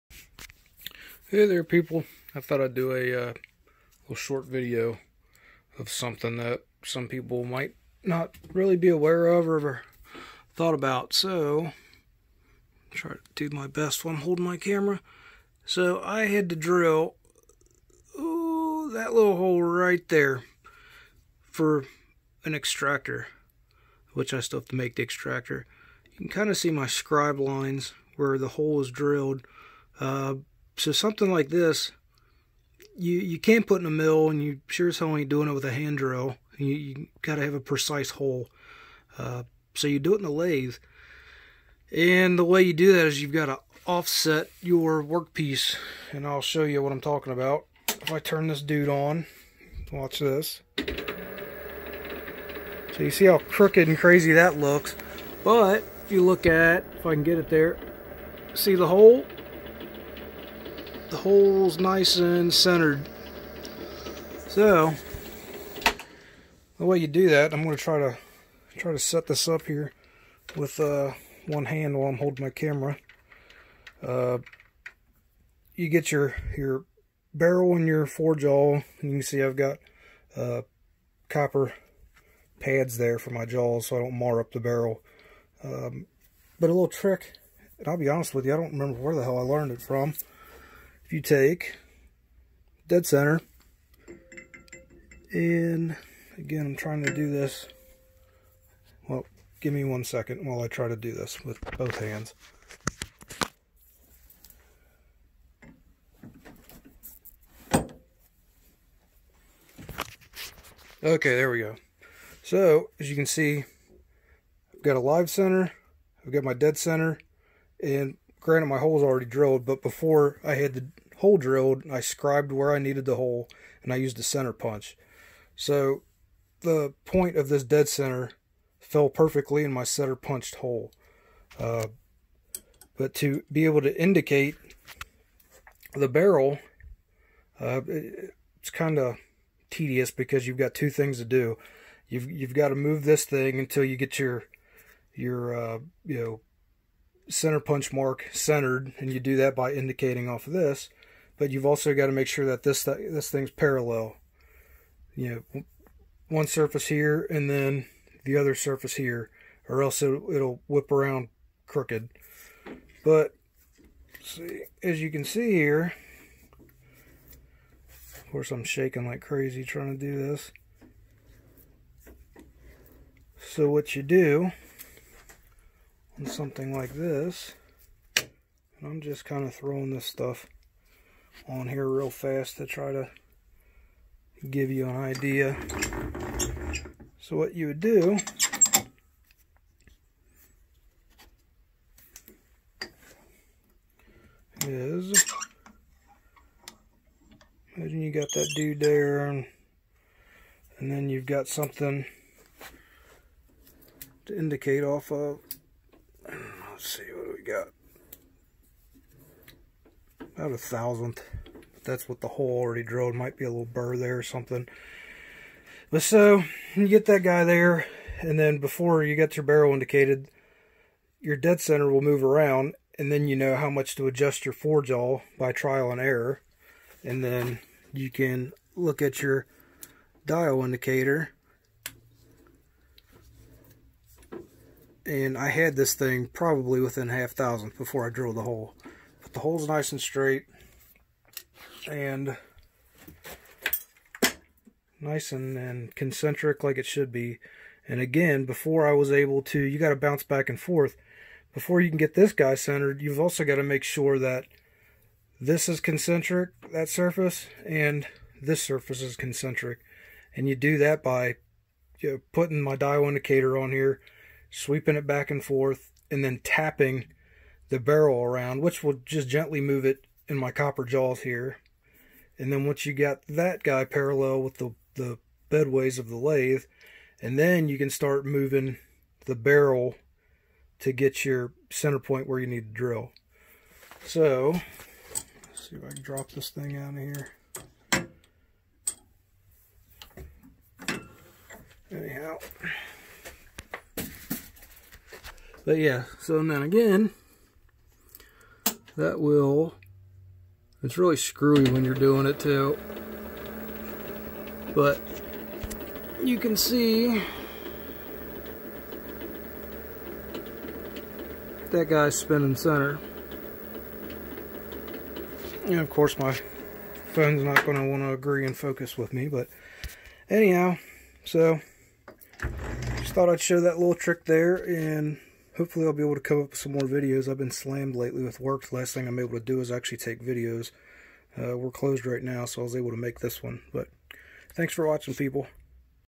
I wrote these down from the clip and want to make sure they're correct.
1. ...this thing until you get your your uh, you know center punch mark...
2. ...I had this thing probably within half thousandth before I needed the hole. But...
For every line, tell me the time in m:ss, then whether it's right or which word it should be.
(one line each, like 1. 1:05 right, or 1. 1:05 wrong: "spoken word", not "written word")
1. 2:23 right
2. 3:55 wrong: "drilled", not "needed".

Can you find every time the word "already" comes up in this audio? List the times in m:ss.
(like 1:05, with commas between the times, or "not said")
1:59, 3:32.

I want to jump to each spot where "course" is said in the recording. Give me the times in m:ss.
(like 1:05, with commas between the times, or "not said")
2:48, 5:15.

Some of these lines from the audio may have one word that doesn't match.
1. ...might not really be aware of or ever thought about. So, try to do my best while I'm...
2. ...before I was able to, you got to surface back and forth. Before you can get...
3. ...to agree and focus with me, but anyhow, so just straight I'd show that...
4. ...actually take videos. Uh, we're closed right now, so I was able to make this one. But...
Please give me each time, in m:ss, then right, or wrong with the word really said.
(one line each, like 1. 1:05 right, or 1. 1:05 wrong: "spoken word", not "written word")
1. 0:07 right
2. 4:08 wrong: "bounce", not "surface"
3. 5:18 wrong: "thought", not "straight"
4. 5:29 right.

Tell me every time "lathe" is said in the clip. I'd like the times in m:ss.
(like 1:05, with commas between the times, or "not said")
0:40, 4:36.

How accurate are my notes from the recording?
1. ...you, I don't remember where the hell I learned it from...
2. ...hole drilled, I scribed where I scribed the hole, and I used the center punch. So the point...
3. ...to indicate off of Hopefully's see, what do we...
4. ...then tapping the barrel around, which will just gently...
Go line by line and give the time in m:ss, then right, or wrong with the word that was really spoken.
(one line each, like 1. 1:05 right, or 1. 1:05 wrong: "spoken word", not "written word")
1. 1:28 right
2. 2:01 wrong: "needed", not "scribed"
3. 3:24 wrong: "Let", not "Hopefully"
4. 4:26 right.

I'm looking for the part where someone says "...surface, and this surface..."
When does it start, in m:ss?
4:16.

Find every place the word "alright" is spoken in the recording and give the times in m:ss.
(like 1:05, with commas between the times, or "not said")
not said.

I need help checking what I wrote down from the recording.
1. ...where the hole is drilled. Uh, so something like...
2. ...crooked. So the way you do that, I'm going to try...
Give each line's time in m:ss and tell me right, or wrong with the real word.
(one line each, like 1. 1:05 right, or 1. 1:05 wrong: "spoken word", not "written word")
1. 0:28 right
2. 1:02 wrong: "centered", not "crooked".